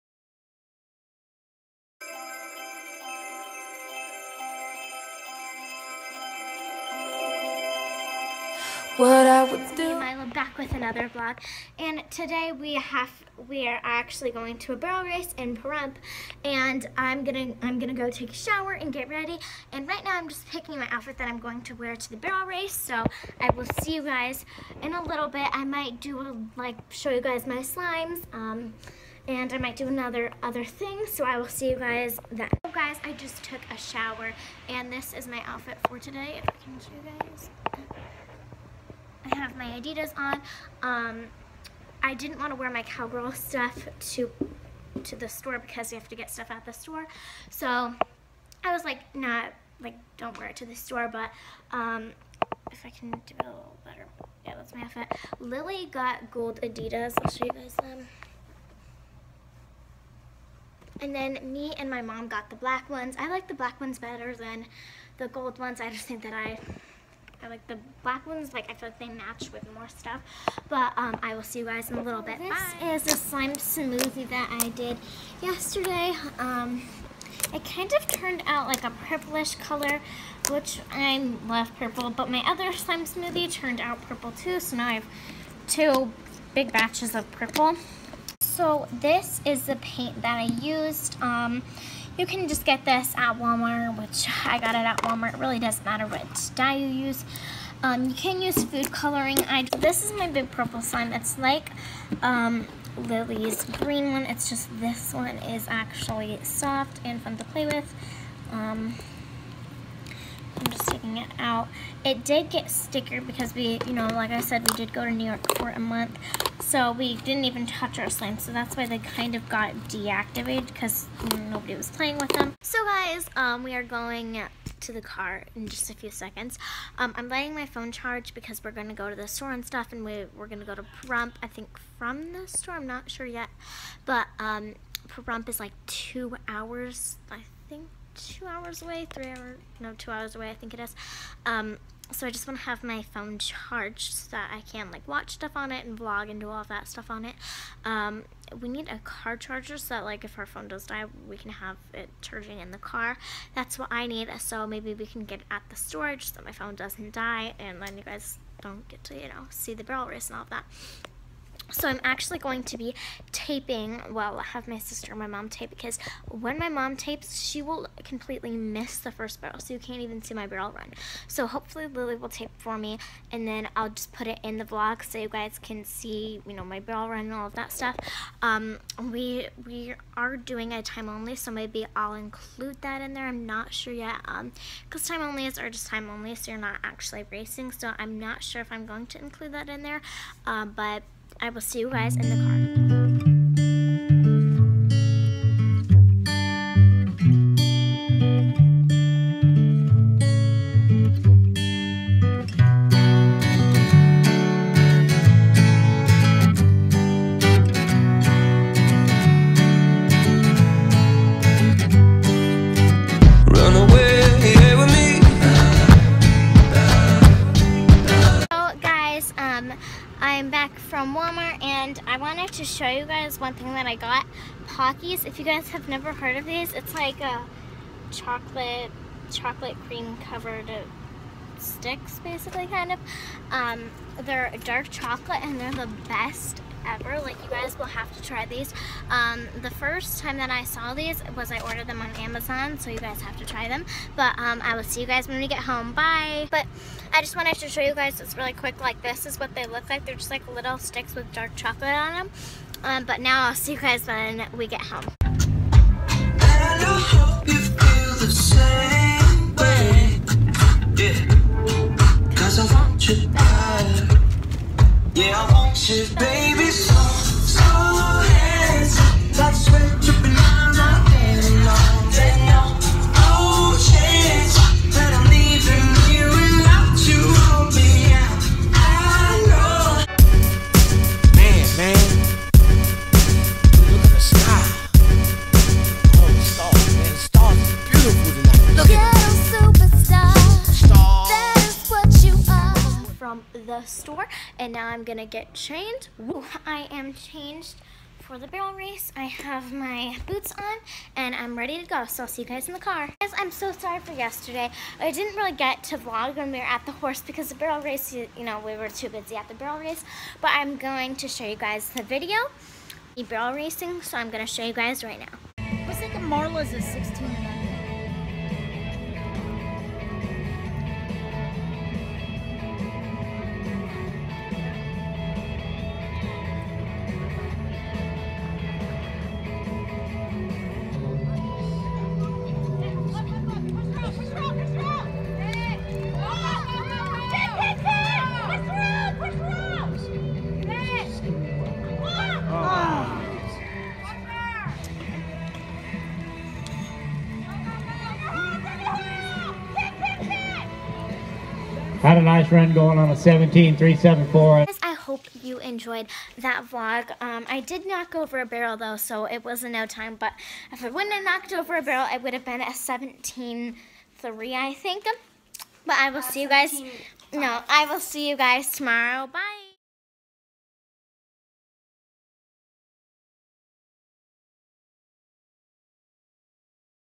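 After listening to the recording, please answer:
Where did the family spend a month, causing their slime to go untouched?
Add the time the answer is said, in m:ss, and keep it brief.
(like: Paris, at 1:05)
New York, at 1:55.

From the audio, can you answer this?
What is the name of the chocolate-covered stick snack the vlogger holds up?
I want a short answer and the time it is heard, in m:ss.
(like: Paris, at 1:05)
Pockies, at 3:44.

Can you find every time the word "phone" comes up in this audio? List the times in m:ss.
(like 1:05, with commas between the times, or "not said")
2:07, 2:23, 2:30, 2:36.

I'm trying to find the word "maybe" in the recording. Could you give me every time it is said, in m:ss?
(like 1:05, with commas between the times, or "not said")
2:34, 3:01.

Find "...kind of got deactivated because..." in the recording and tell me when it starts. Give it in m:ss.
1:58.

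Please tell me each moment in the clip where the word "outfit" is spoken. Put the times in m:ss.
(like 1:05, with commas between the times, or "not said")
0:20, 0:35, 0:54.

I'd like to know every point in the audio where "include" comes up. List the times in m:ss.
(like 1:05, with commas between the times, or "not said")
3:02, 3:09.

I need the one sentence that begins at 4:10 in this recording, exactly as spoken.
They're just like little sticks with dark chocolate on them.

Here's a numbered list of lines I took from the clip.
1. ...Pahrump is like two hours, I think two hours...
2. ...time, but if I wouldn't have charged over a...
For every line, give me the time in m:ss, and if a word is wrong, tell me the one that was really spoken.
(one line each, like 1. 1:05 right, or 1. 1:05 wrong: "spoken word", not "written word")
1. 2:15 right
2. 5:59 wrong: "knocked", not "charged".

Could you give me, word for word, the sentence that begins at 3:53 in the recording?
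Um, they're dark chocolate and they're the best ever.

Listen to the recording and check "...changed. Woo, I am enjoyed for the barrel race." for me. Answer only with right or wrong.
wrong.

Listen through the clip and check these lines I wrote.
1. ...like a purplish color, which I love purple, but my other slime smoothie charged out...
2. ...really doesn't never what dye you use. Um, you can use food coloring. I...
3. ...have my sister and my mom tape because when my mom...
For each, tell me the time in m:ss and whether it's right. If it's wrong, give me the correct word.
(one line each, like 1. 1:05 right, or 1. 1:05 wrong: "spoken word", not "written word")
1. 1:18 wrong: "turned", not "charged"
2. 1:35 wrong: "matter", not "never"
3. 2:44 right.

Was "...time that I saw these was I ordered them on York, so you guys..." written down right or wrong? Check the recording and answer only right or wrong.
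wrong.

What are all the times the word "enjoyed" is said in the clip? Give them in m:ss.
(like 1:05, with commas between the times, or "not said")
5:55.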